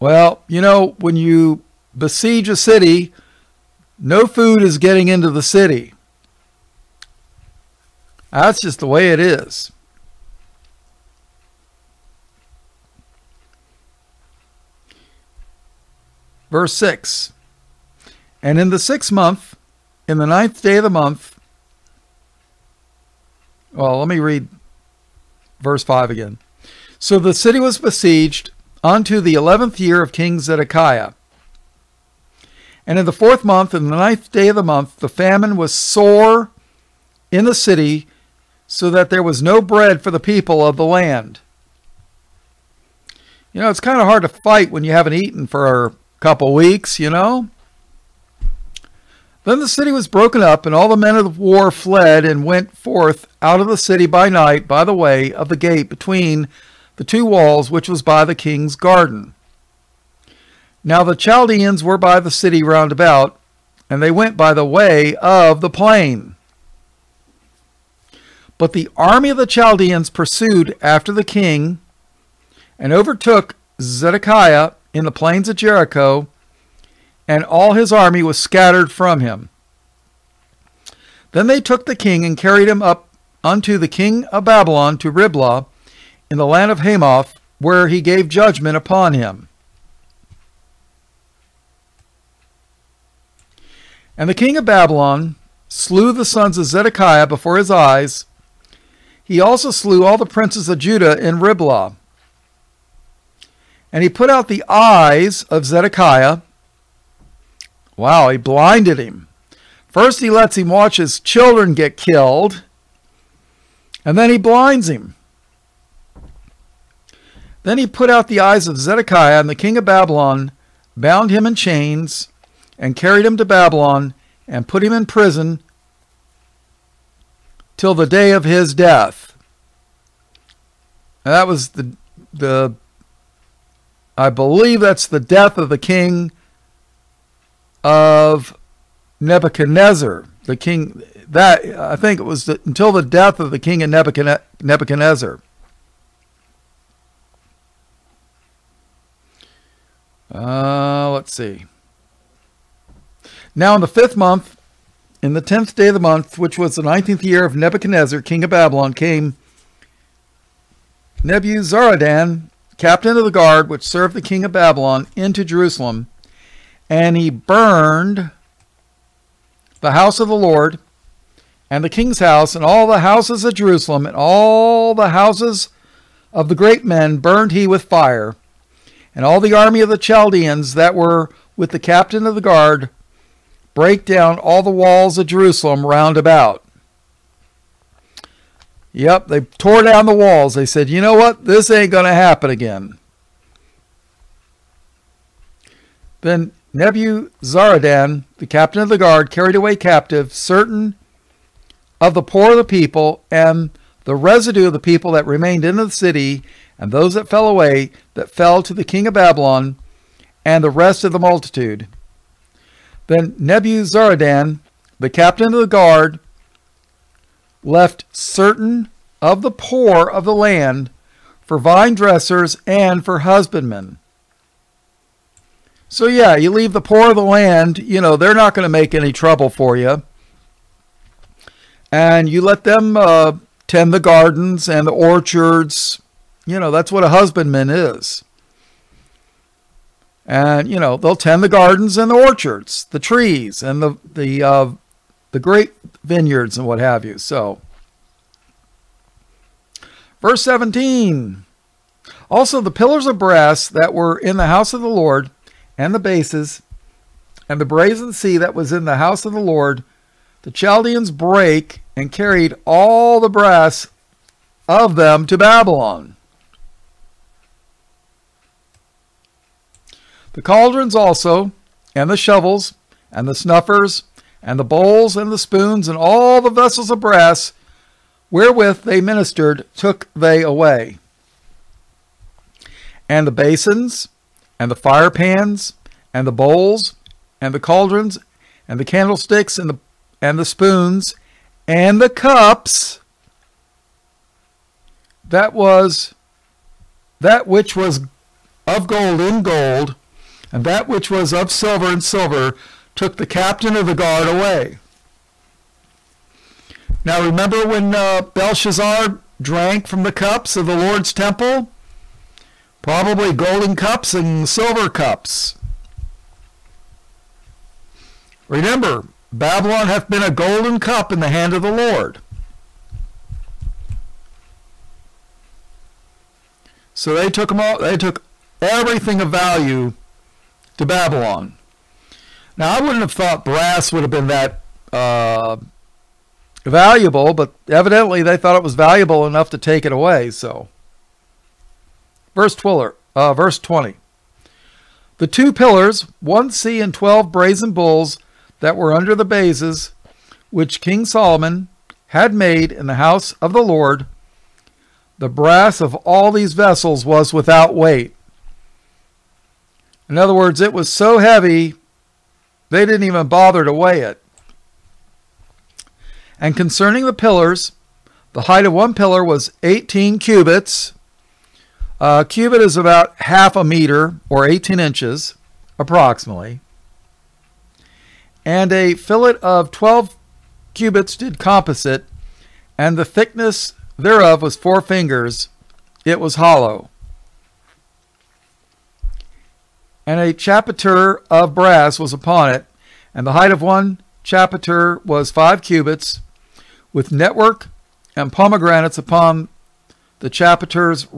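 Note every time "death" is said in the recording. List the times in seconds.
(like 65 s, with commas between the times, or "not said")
128 s, 135 s, 143 s.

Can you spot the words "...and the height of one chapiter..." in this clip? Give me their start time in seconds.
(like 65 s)
393 s.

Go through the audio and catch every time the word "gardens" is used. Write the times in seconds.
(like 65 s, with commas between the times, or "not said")
58 s, 233 s, 241 s.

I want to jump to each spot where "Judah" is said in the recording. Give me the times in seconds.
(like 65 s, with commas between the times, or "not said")
100 s.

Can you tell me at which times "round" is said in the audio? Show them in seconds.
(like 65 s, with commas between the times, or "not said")
62 s, 185 s.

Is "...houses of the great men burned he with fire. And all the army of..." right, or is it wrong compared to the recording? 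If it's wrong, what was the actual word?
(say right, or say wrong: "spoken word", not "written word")
right.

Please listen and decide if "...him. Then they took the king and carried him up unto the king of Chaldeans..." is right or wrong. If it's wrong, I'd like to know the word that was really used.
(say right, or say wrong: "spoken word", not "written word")
wrong: "Babylon", not "Chaldeans".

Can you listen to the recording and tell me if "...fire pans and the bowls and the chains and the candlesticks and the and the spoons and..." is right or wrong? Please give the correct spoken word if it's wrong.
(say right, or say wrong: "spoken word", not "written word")
wrong: "cauldrons", not "chains".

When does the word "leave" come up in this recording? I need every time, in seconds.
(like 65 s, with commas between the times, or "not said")
226 s.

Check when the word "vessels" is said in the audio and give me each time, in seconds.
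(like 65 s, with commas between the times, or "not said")
276 s, 356 s.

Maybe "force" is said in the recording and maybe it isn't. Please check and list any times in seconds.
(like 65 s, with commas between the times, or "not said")
not said.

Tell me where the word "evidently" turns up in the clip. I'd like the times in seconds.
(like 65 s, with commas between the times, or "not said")
337 s.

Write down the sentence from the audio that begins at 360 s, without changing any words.
In other words, it was so heavy, they didn't even bother to weigh it.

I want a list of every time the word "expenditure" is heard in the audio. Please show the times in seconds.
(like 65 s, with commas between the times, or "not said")
not said.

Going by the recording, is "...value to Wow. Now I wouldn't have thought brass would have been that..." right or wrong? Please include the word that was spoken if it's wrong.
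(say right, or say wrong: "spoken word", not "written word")
wrong: "Babylon", not "Wow".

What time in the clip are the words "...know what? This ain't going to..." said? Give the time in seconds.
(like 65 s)
191 s.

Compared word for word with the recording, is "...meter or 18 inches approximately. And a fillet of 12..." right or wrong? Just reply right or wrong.
right.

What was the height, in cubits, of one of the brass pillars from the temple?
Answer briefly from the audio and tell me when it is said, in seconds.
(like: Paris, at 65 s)
18 cubits, at 369 s.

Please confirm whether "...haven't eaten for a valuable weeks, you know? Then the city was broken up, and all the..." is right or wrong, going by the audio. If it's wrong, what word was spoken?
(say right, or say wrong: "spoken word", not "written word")
wrong: "couple", not "valuable".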